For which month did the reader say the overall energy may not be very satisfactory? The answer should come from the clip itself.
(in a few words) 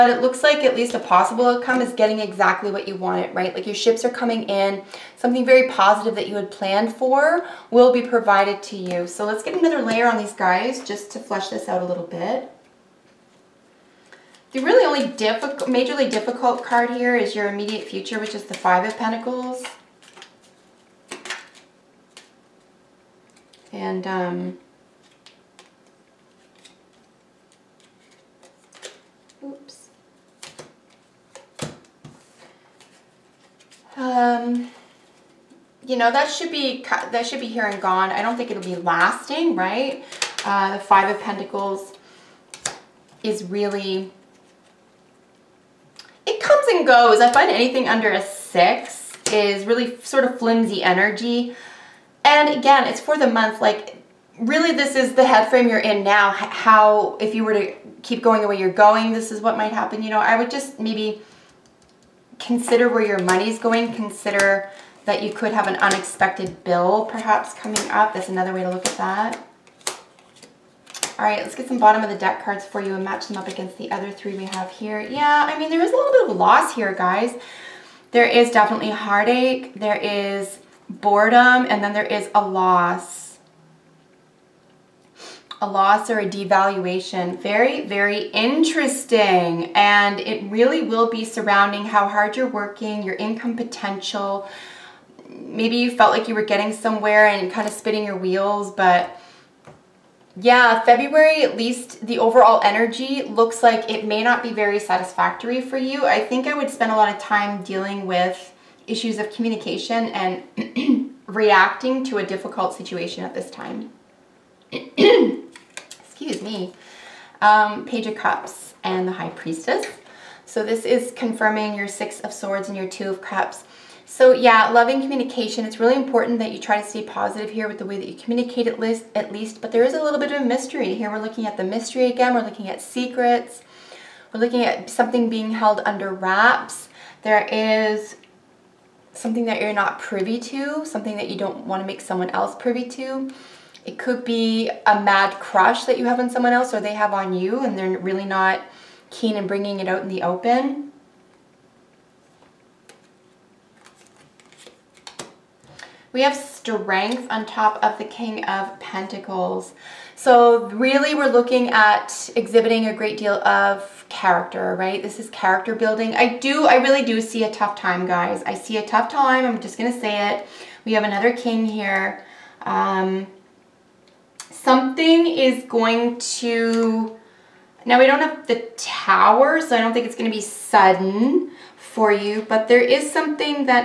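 February.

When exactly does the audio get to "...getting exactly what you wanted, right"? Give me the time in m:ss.
0:01.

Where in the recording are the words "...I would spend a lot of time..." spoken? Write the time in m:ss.
1:46.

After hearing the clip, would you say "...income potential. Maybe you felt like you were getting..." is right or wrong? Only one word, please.
right.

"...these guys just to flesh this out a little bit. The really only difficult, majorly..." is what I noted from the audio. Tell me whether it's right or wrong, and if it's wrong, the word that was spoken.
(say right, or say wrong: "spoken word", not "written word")
right.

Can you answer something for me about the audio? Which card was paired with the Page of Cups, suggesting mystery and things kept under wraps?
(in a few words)
The High Priestess.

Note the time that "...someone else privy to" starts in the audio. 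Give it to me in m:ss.
2:22.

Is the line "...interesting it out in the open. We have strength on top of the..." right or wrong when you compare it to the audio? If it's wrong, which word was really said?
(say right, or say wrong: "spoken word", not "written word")
wrong: "bringing", not "interesting".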